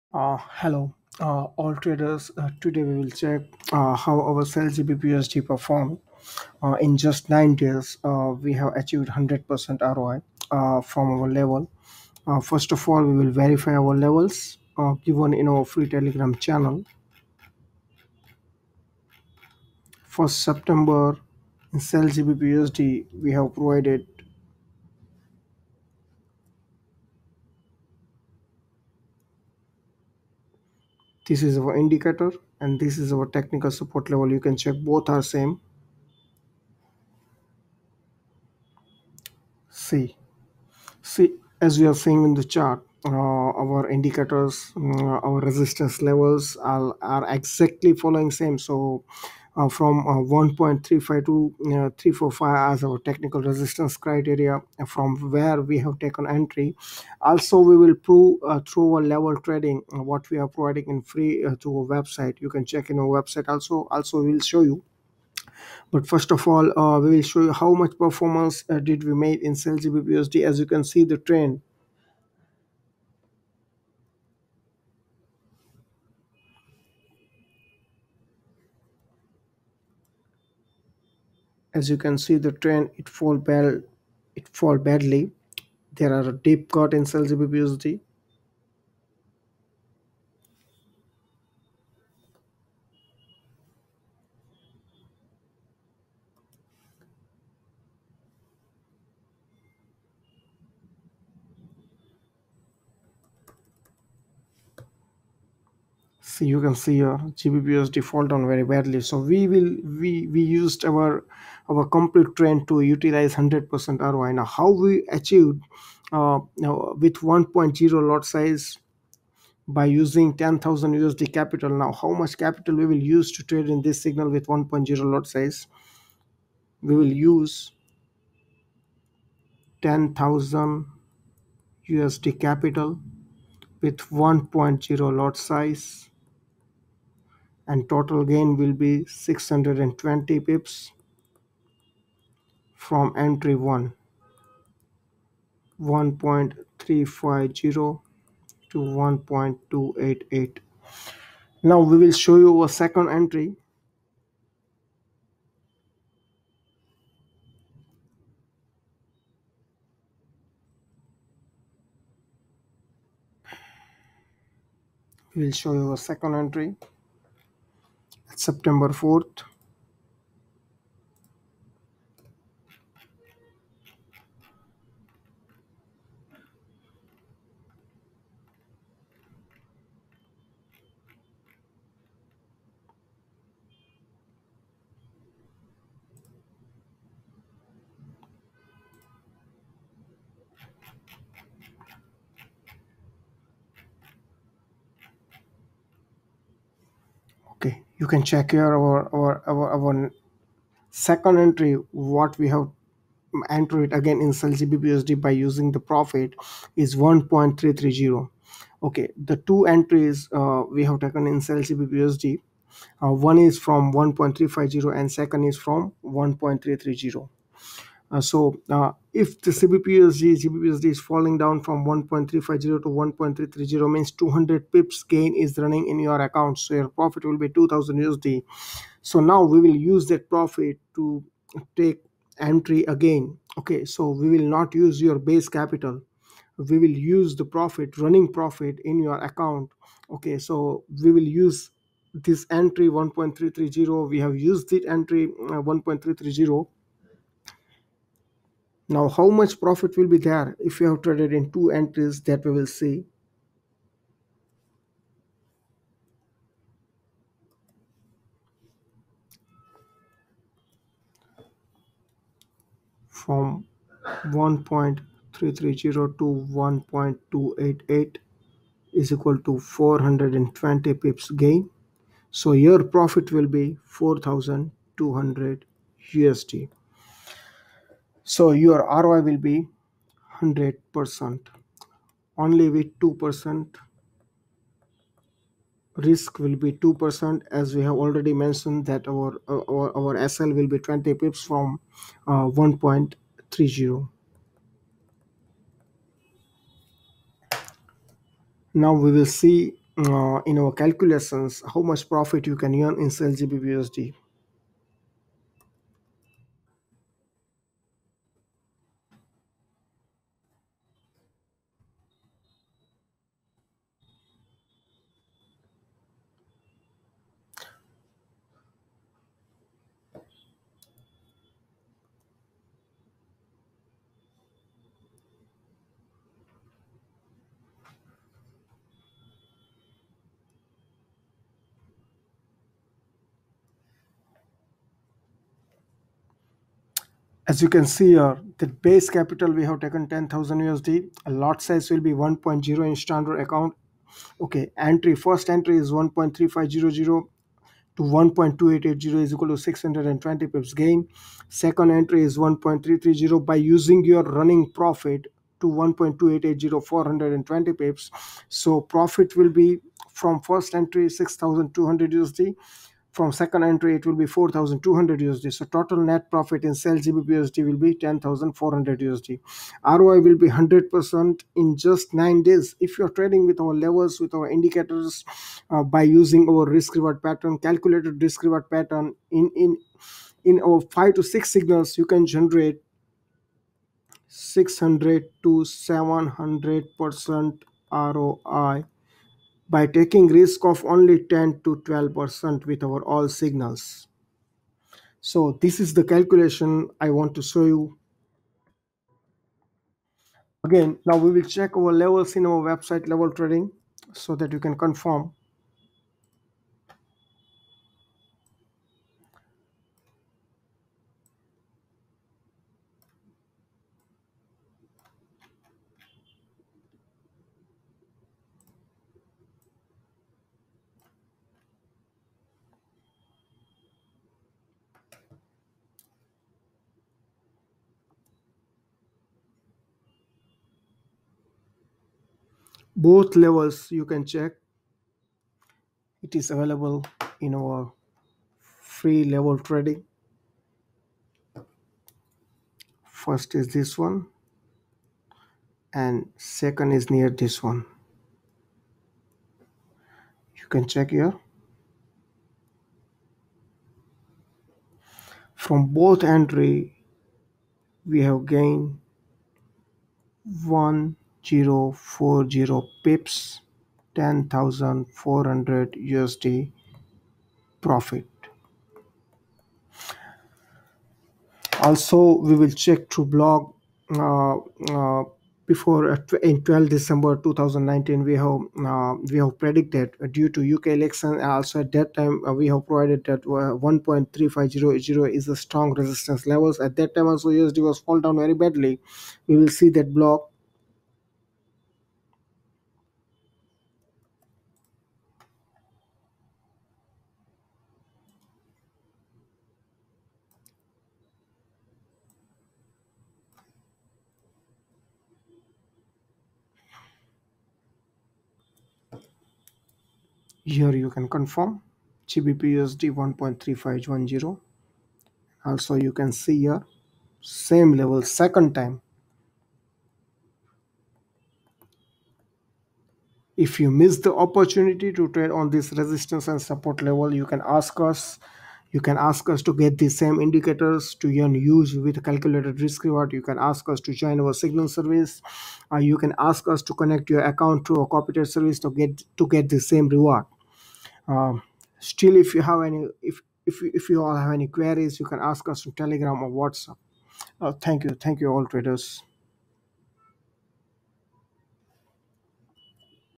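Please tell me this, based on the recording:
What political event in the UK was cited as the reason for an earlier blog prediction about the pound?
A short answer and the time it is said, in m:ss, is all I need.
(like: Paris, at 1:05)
UK election, at 8:00.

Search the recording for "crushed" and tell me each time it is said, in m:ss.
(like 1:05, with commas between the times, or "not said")
not said.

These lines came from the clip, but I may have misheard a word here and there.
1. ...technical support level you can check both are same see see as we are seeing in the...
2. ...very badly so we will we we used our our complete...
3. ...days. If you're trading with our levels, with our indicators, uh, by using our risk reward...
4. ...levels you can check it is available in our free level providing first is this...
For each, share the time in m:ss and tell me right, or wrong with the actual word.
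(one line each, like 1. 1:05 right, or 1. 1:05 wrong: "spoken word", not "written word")
1. 0:33 right
2. 1:48 right
3. 6:12 right
4. 7:13 wrong: "trading", not "providing".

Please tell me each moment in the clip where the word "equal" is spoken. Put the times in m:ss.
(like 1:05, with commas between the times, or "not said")
4:29, 5:49.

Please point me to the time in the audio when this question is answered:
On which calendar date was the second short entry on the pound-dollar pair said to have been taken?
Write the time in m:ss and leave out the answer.
2:48.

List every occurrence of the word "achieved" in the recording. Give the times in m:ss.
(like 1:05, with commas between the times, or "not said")
0:08, 1:55.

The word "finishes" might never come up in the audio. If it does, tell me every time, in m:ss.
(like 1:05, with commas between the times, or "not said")
not said.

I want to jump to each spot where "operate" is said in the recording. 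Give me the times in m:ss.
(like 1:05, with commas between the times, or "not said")
not said.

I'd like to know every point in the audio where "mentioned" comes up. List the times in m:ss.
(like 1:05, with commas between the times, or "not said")
4:48.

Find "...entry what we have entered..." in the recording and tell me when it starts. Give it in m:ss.
3:21.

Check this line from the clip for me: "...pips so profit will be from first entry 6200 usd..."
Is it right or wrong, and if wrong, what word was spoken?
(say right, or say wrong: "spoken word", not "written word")
right.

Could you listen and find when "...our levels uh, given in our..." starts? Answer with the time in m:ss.
0:13.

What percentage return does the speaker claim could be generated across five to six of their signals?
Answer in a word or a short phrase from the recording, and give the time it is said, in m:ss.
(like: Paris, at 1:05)
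600 to 700 percent, at 6:24.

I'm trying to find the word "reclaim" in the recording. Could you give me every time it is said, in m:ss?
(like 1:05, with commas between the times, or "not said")
not said.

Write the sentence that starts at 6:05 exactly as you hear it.
So total net profit in sell GBPUSD will be 10,400 USD.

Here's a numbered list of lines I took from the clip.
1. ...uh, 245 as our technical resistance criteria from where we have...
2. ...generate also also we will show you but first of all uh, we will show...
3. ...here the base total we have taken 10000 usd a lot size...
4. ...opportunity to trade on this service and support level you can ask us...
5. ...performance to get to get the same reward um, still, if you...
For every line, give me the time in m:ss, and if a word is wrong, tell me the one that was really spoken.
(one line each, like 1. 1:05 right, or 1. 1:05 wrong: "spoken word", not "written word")
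1. 0:51 wrong: "345", not "245"
2. 1:03 wrong: "website", not "generate"
3. 5:38 wrong: "capital", not "total"
4. 8:44 wrong: "resistance", not "service"
5. 8:58 wrong: "service", not "performance".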